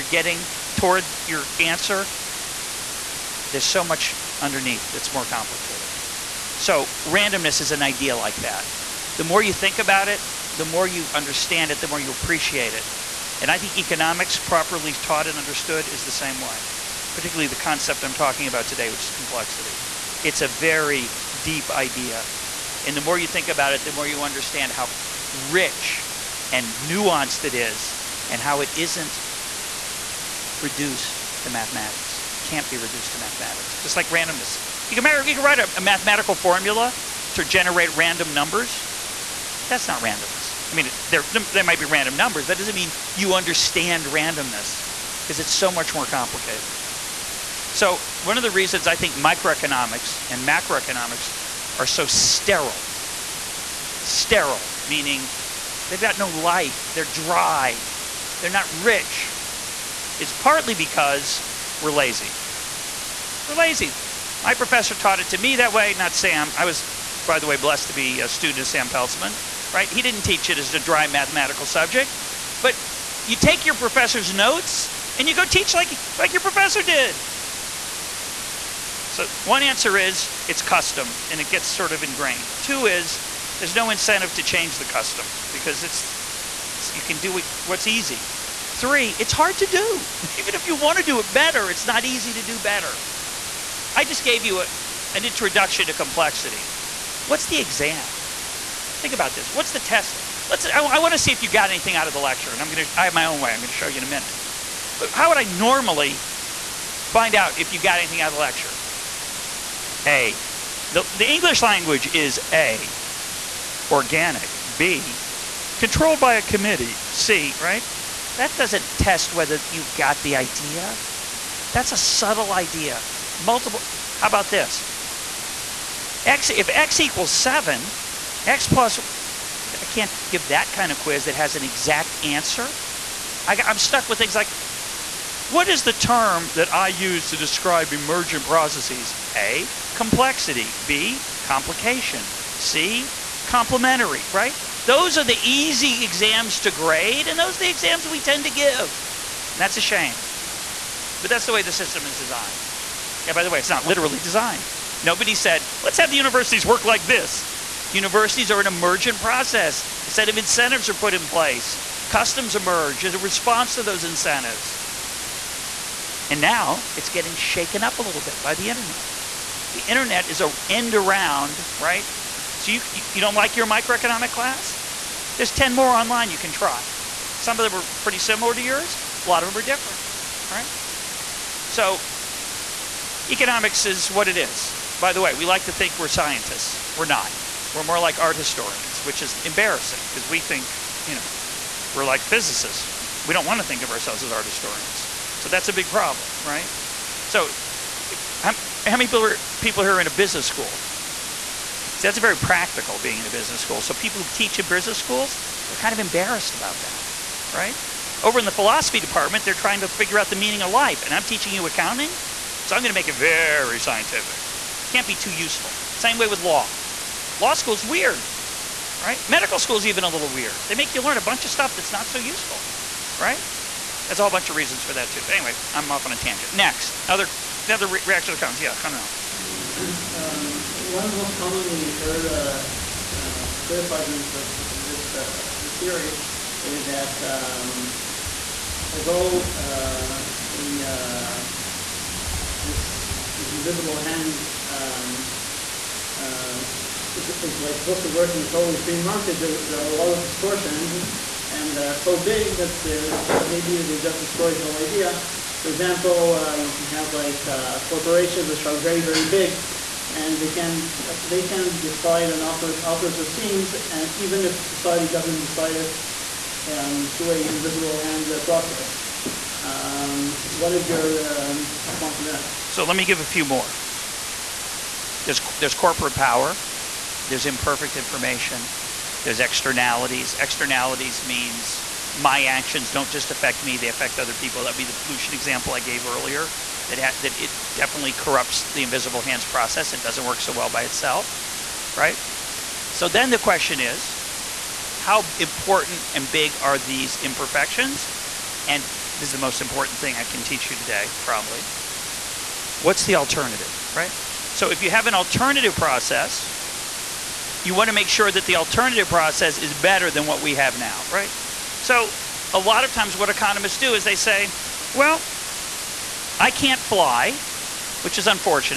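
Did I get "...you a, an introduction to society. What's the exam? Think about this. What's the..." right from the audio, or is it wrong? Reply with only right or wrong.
wrong.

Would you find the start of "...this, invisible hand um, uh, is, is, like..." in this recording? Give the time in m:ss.
4:03.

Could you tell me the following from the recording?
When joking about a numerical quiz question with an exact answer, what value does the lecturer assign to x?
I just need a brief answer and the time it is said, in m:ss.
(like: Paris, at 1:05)
7, at 2:07.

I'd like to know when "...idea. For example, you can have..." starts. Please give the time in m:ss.
4:14.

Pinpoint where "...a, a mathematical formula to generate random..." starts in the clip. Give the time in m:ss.
0:35.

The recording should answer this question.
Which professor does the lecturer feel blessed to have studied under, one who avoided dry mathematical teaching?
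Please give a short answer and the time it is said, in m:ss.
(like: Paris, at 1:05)
Sam Peltzman, at 1:08.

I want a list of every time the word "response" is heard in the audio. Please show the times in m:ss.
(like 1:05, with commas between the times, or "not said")
2:43, 4:31.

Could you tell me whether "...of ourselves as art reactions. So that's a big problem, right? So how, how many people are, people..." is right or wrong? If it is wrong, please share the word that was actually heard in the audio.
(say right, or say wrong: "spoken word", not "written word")
wrong: "historians", not "reactions".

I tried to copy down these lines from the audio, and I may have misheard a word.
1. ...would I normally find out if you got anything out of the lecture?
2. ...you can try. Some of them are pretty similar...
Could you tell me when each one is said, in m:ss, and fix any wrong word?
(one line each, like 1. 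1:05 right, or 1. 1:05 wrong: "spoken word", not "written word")
1. 1:45 right
2. 2:56 right.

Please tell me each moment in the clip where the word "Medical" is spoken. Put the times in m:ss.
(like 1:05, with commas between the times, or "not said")
3:39.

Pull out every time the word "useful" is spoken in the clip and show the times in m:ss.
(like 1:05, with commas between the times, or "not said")
3:35, 3:42.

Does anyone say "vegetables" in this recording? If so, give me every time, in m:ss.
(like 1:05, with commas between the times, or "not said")
not said.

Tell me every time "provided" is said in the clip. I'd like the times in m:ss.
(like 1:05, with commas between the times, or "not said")
not said.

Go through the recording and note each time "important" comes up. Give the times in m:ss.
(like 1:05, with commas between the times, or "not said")
4:55, 4:59.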